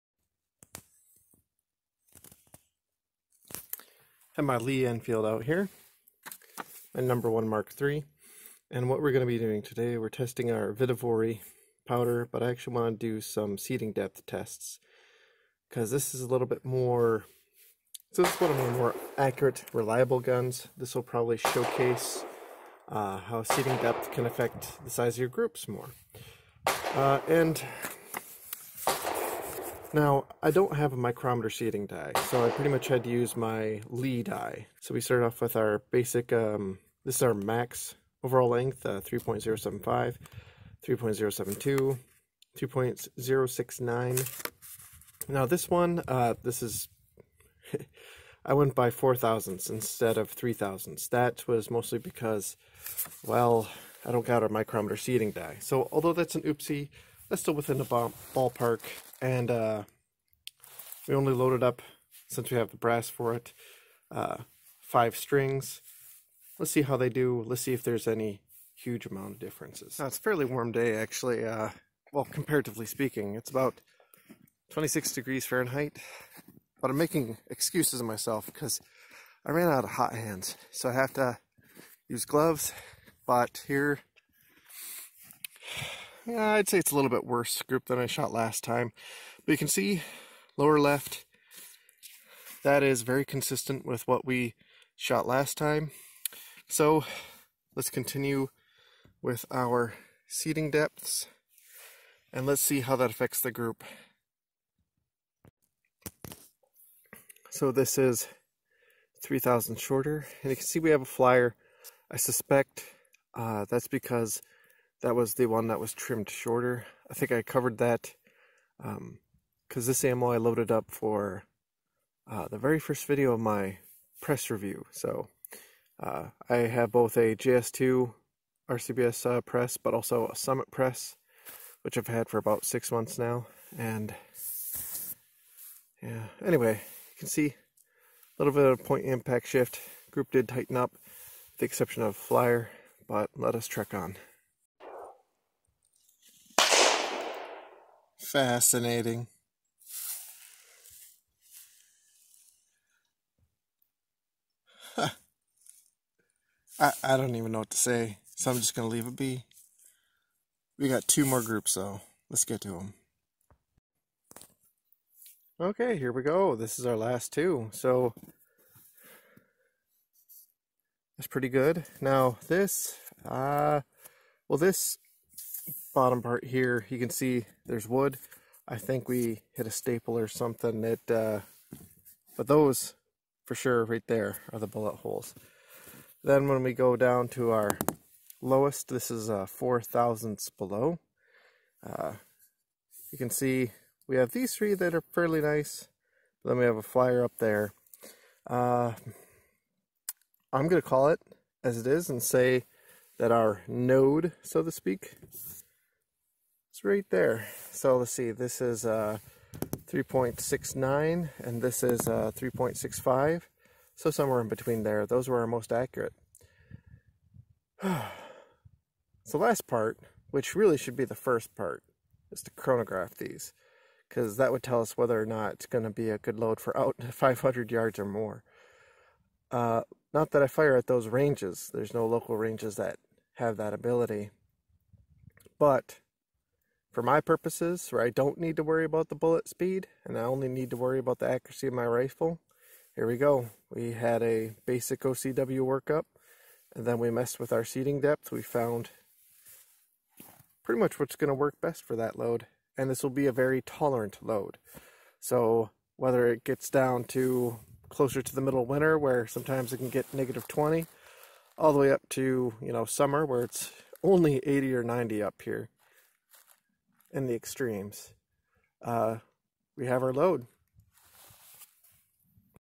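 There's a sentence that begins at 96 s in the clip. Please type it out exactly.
So let's continue with our seating depths and let's see how that affects the group.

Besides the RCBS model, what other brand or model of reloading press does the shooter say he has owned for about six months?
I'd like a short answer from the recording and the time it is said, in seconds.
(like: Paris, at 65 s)
Summit, at 130 s.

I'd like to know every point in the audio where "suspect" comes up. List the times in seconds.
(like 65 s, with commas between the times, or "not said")
112 s.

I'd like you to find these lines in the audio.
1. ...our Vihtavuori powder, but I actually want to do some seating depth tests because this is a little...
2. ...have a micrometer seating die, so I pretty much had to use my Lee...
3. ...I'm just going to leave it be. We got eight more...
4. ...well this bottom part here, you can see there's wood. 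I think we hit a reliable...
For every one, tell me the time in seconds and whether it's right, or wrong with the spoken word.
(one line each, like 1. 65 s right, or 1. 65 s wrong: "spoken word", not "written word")
1. 10 s right
2. 30 s right
3. 158 s wrong: "two", not "eight"
4. 174 s wrong: "staple", not "reliable".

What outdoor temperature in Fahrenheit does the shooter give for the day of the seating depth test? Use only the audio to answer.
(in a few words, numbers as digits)
26 degrees.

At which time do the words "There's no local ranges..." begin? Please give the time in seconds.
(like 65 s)
231 s.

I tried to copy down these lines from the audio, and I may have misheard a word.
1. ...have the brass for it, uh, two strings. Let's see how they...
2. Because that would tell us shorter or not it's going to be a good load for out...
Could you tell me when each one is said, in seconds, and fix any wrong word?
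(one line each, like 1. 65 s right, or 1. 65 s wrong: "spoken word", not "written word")
1. 62 s wrong: "five", not "two"
2. 224 s wrong: "whether", not "shorter".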